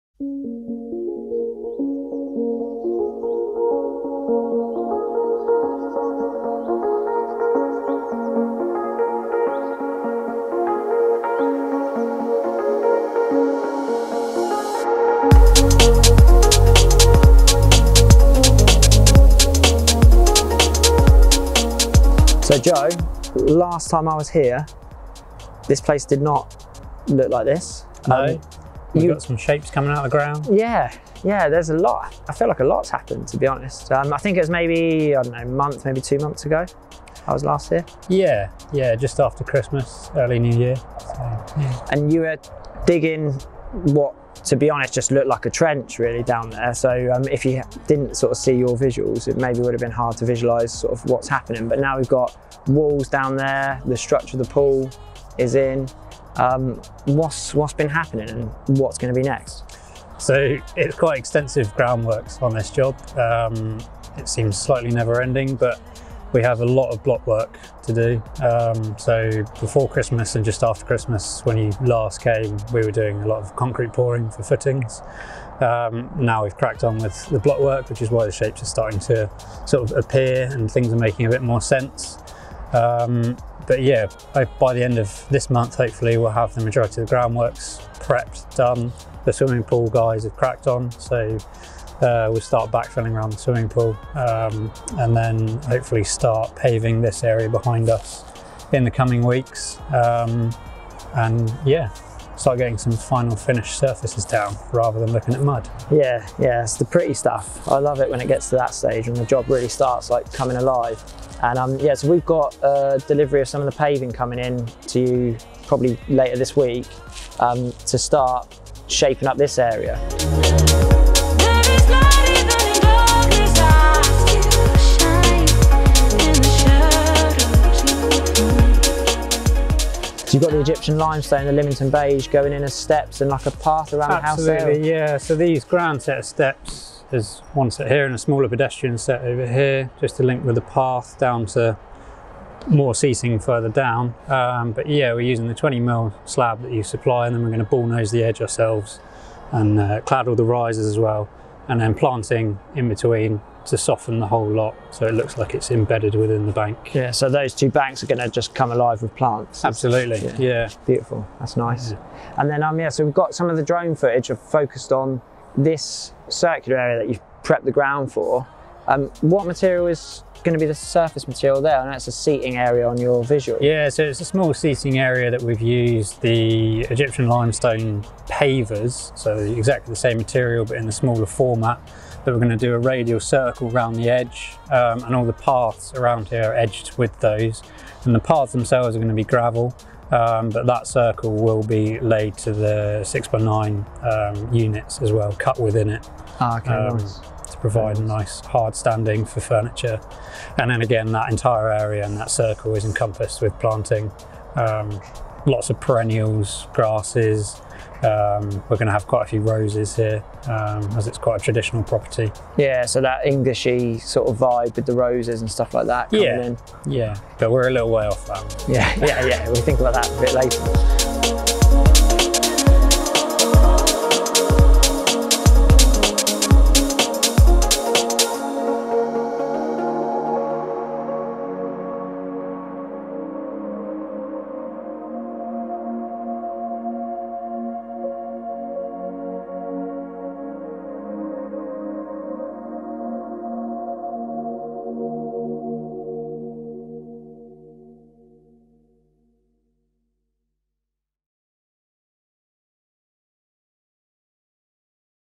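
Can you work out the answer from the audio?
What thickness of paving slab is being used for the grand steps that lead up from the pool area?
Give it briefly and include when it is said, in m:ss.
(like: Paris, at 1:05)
20 mil, at 2:25.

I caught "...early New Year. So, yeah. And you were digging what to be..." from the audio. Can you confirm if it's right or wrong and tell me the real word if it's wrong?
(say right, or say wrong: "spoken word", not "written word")
right.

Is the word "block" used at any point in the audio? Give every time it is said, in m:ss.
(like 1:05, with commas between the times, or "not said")
1:07, 1:17.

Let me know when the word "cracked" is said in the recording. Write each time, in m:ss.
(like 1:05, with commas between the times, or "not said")
1:16, 1:30.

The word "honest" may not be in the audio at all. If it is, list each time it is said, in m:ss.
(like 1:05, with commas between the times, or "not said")
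0:33, 0:44.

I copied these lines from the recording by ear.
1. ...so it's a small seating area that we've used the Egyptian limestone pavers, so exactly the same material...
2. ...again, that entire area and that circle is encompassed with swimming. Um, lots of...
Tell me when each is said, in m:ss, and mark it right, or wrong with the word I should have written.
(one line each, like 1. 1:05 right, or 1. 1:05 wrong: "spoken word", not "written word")
1. 2:53 right
2. 3:20 wrong: "planting", not "swimming".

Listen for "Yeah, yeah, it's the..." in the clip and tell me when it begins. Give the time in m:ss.
1:45.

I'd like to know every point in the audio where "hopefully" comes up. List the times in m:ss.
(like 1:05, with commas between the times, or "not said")
1:25, 1:35.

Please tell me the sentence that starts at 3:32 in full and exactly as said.
Yeah, so that Englishy sort of vibe with the roses and stuff like that.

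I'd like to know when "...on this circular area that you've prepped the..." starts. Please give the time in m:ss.
2:44.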